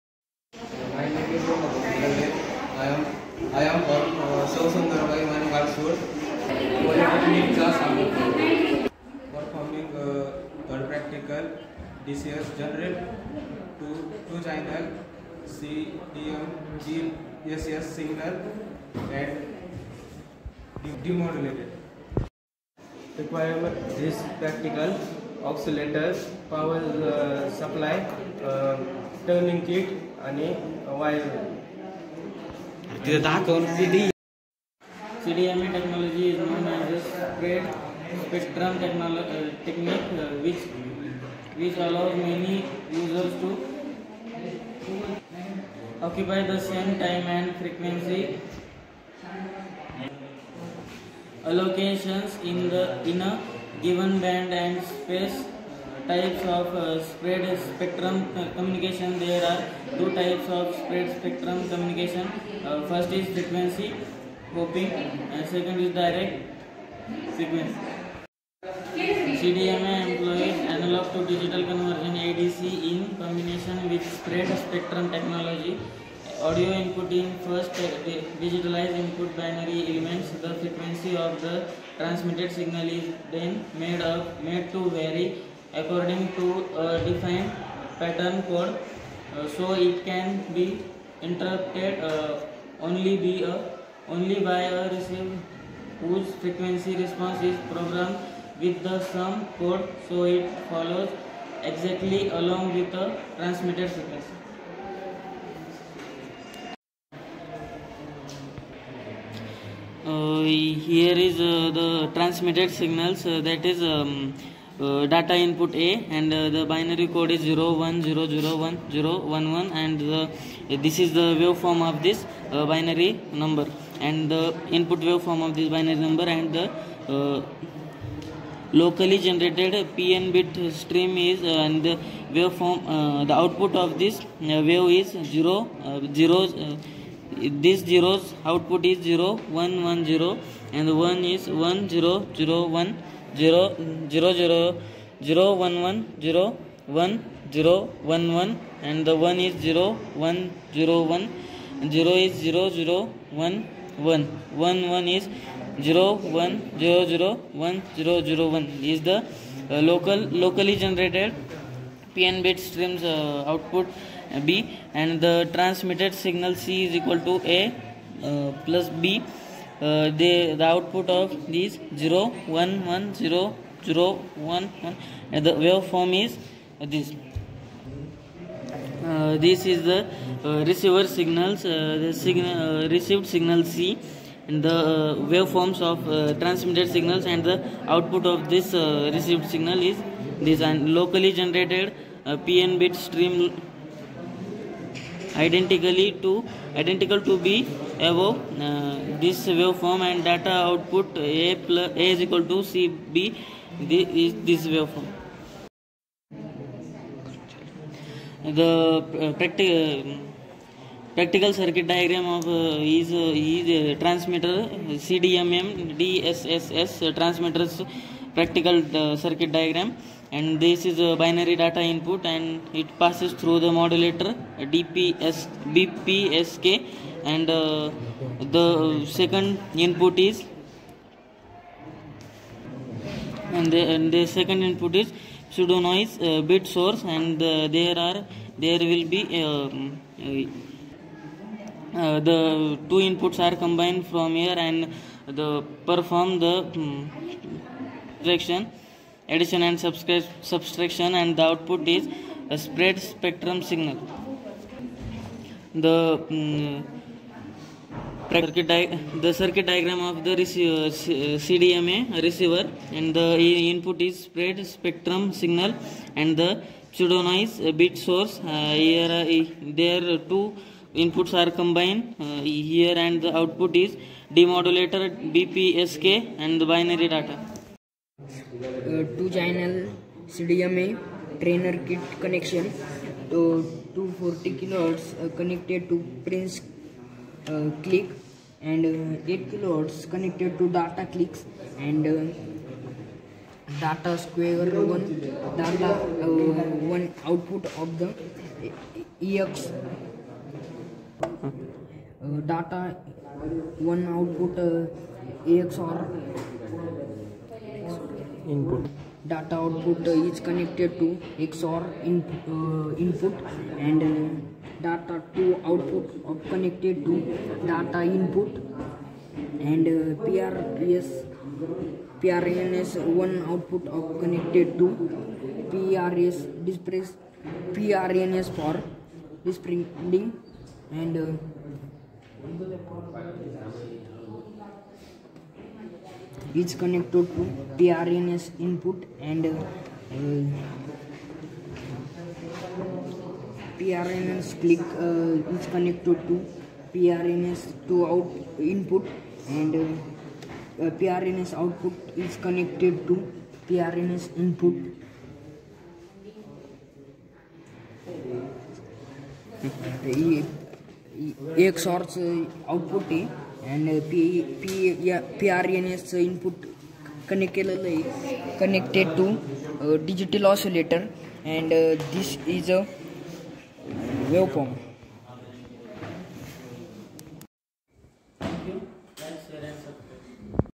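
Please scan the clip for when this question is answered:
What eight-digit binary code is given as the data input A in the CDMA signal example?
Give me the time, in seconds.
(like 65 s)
117 s.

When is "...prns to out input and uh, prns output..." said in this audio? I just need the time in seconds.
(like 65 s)
346 s.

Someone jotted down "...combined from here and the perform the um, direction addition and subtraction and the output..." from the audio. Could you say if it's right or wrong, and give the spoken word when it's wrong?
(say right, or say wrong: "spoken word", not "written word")
right.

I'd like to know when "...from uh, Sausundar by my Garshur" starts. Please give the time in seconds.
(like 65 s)
3 s.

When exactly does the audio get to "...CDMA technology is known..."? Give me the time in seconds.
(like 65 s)
35 s.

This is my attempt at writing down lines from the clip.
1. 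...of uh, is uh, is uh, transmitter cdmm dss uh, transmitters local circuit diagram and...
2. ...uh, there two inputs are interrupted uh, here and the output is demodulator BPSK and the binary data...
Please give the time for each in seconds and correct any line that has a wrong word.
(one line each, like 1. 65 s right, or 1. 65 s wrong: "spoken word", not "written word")
1. 212 s wrong: "practical", not "local"
2. 269 s wrong: "combined", not "interrupted".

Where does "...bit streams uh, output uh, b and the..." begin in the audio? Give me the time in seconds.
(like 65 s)
162 s.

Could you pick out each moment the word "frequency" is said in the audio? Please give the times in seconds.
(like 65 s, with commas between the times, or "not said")
47 s, 63 s, 80 s, 96 s, 103 s.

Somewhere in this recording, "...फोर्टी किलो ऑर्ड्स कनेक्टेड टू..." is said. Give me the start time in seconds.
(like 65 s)
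284 s.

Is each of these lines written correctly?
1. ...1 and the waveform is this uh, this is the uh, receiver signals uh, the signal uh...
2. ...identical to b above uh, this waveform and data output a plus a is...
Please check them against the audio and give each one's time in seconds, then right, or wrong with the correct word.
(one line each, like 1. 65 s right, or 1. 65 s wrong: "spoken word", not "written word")
1. 174 s right
2. 196 s right.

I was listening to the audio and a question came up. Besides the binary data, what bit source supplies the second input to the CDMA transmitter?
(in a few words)
Pseudo noise bit source.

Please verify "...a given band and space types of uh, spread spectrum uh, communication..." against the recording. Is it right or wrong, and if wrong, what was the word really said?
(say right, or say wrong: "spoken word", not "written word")
right.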